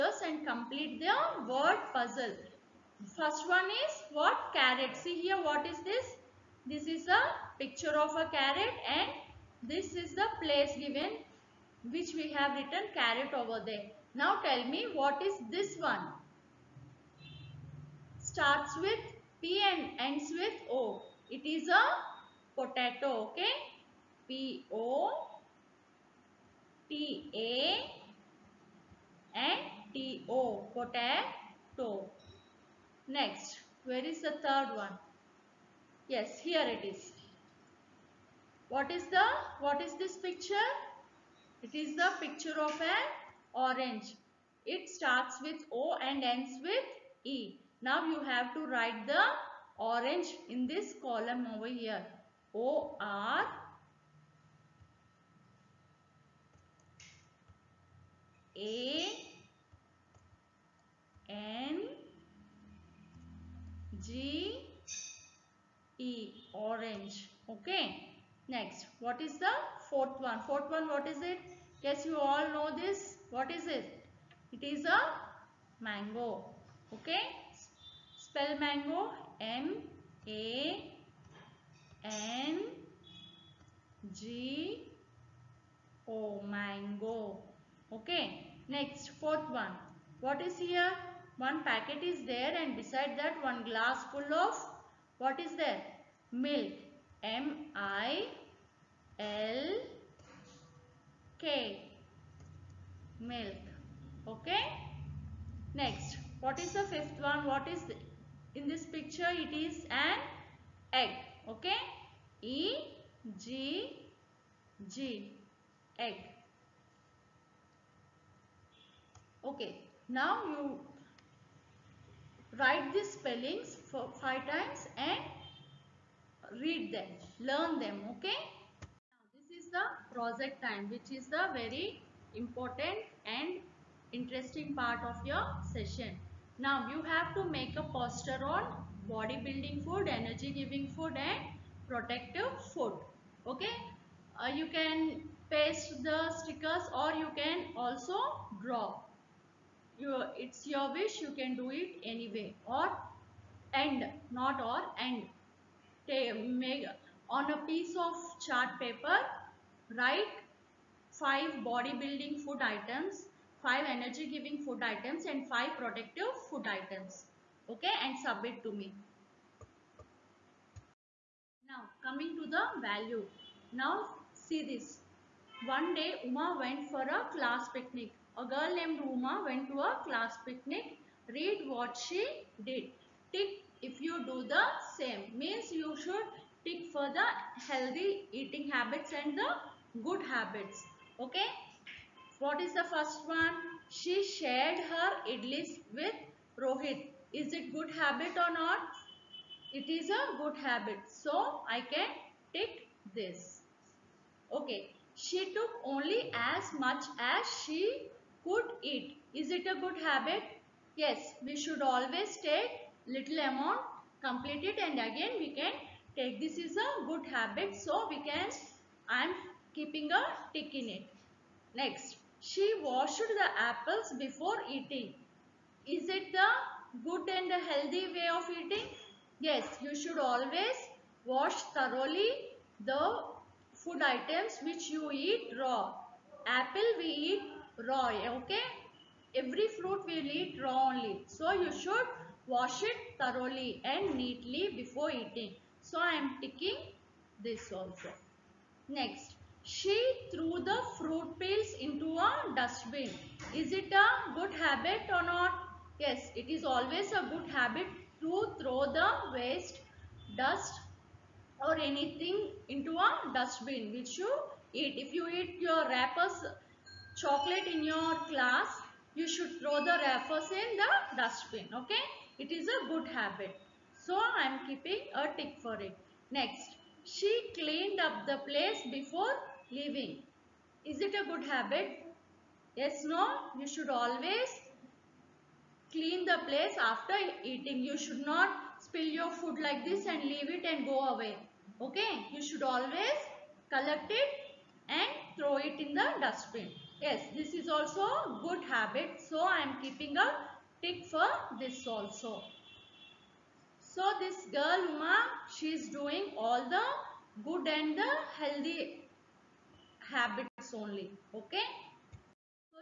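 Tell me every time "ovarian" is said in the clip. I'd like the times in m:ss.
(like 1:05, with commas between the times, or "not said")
not said.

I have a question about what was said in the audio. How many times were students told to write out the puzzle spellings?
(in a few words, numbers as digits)
5.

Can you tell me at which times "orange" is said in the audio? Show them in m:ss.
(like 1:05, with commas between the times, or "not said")
0:43, 0:49, 1:06.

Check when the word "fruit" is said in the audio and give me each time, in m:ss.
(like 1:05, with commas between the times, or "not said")
3:59, 4:10.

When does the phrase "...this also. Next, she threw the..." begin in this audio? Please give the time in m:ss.
4:07.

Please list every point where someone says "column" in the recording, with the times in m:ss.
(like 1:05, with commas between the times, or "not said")
0:50.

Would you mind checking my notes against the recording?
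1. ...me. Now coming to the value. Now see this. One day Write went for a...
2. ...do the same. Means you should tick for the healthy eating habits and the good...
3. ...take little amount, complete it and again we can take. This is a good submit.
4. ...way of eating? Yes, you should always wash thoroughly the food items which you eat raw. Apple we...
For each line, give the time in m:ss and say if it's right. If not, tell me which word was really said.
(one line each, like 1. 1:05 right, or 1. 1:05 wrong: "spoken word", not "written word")
1. 2:48 wrong: "Uma", not "Write"
2. 3:04 right
3. 3:32 wrong: "habit", not "submit"
4. 3:48 right.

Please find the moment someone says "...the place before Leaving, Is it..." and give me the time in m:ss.
4:38.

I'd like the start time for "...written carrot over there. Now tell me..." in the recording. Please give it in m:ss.
0:12.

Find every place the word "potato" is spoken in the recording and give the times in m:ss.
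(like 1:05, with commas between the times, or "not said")
0:22, 0:30.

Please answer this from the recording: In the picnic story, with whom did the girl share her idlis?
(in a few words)
Rohit.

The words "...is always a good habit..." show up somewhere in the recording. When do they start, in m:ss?
4:16.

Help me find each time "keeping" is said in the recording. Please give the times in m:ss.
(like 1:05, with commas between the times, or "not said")
3:39, 4:34, 4:59.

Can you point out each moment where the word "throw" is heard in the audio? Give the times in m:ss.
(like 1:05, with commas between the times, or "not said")
4:18, 4:29, 4:55.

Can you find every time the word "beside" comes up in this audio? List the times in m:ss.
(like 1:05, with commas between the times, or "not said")
1:32.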